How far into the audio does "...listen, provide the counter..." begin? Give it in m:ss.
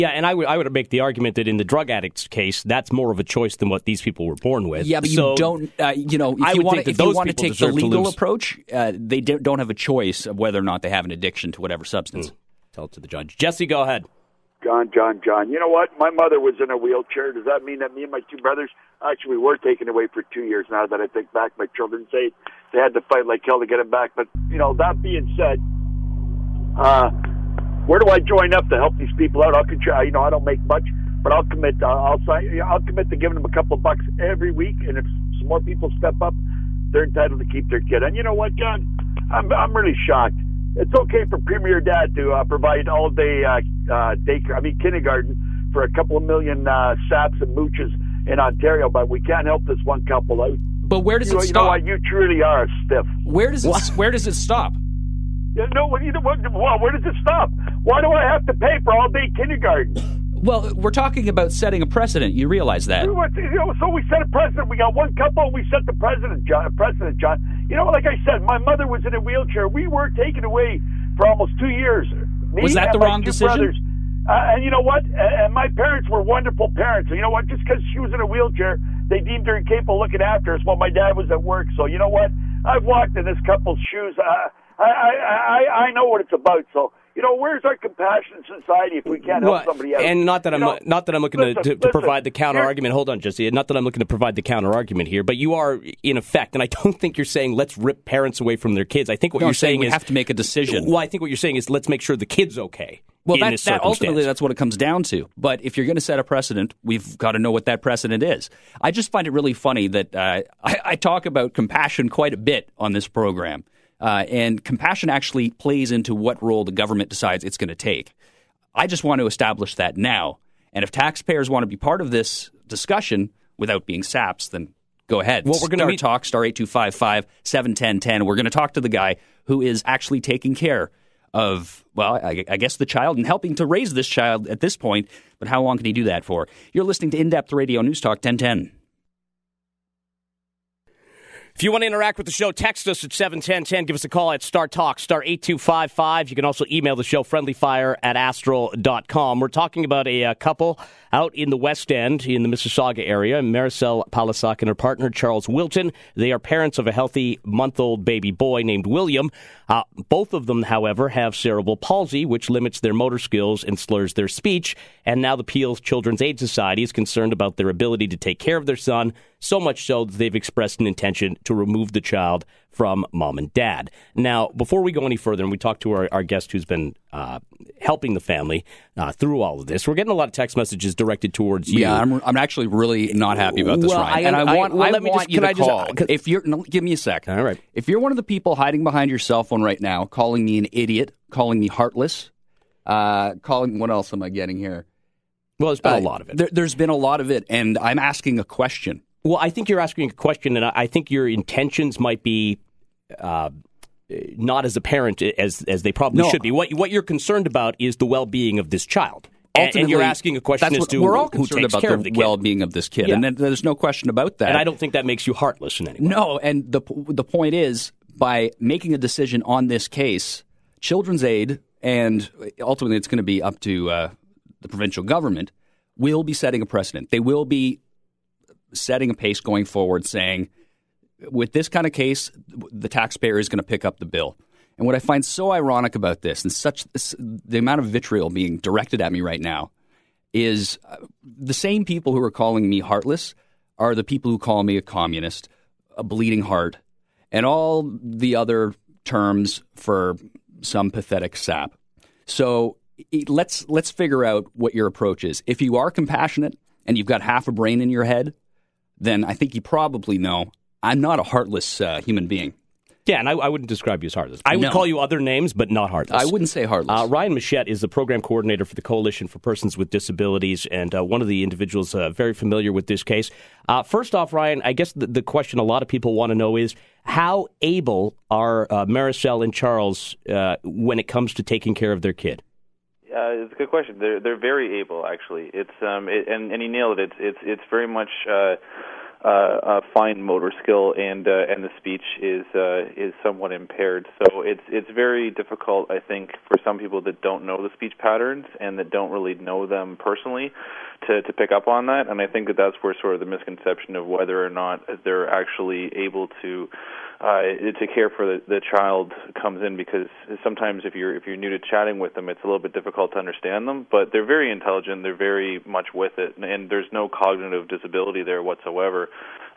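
1:31.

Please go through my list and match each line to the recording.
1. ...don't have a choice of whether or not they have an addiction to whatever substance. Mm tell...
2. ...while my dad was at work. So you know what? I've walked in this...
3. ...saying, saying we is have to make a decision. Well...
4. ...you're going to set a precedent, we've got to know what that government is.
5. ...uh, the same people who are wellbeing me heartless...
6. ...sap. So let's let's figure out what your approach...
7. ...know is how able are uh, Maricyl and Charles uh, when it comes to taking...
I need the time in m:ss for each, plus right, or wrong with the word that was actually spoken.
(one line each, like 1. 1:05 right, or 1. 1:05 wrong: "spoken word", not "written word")
1. 0:09 right
2. 1:20 right
3. 1:39 right
4. 1:45 wrong: "precedent", not "government"
5. 4:00 wrong: "calling", not "wellbeing"
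6. 4:11 right
7. 4:36 right.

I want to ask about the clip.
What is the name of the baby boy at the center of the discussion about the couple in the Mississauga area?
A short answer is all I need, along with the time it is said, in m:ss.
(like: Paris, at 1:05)
William, at 2:38.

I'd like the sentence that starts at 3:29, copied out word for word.
Ultimately, and you're asking a question as to we're all concerned about the, the well-being of this kid, yeah.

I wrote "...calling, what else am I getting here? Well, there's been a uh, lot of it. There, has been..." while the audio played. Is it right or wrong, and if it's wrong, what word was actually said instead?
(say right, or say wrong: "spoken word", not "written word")
right.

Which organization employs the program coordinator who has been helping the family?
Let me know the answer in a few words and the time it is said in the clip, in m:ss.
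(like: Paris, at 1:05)
Coalition for Persons with Disabilities, at 4:28.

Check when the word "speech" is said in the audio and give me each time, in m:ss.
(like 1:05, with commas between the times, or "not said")
2:44, 4:51, 4:57.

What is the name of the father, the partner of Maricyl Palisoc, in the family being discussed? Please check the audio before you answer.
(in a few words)
Charles Wilton.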